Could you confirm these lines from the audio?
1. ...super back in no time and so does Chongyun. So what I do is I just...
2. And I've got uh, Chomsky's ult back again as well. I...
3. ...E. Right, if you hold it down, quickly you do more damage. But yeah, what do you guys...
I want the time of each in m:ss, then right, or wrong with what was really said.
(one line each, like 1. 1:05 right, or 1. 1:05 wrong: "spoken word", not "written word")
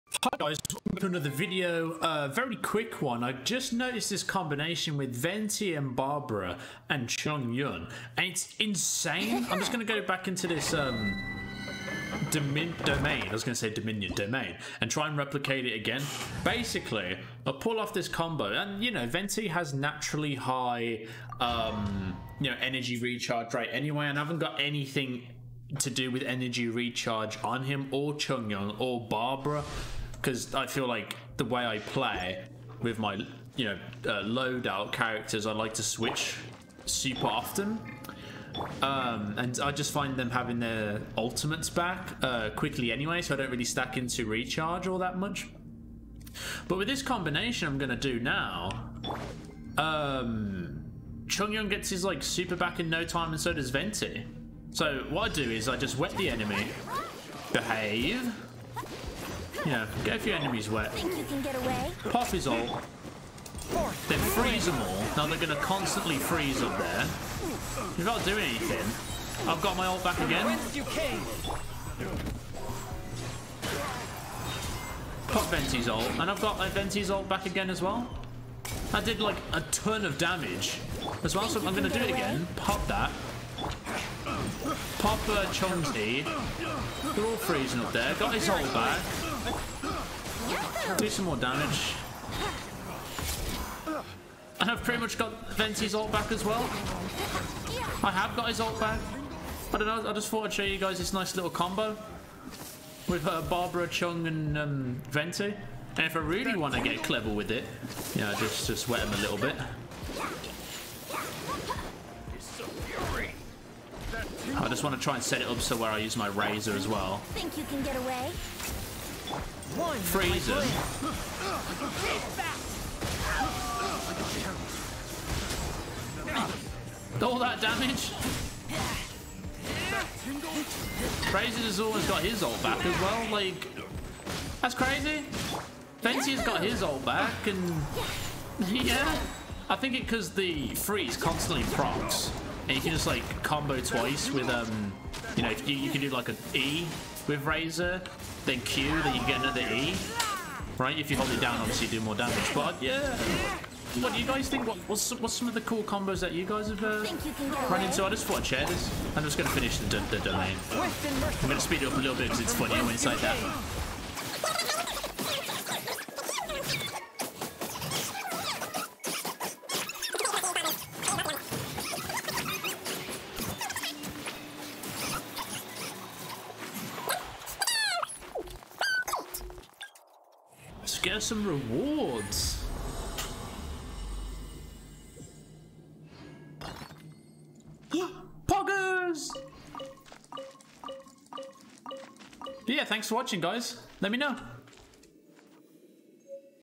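1. 0:52 wrong: "Venti", not "Chongyun"
2. 1:16 wrong: "Venti", not "Chomsky"
3. 2:29 wrong: "obviously", not "quickly".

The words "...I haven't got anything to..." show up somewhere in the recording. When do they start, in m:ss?
0:24.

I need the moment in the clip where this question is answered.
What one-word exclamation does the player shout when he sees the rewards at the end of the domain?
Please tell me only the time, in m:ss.
3:08.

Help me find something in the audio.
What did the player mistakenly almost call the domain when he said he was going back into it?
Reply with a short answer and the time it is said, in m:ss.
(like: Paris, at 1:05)
Dominion, at 0:13.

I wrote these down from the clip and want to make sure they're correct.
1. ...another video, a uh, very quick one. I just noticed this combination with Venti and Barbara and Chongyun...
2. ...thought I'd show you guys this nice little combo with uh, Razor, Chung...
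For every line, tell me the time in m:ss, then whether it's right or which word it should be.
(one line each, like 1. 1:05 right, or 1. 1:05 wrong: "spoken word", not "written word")
1. 0:01 right
2. 1:40 wrong: "Barbara", not "Razor".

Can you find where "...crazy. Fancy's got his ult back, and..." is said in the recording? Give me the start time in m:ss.
2:14.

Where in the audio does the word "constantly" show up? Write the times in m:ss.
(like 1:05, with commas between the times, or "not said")
1:05, 2:21.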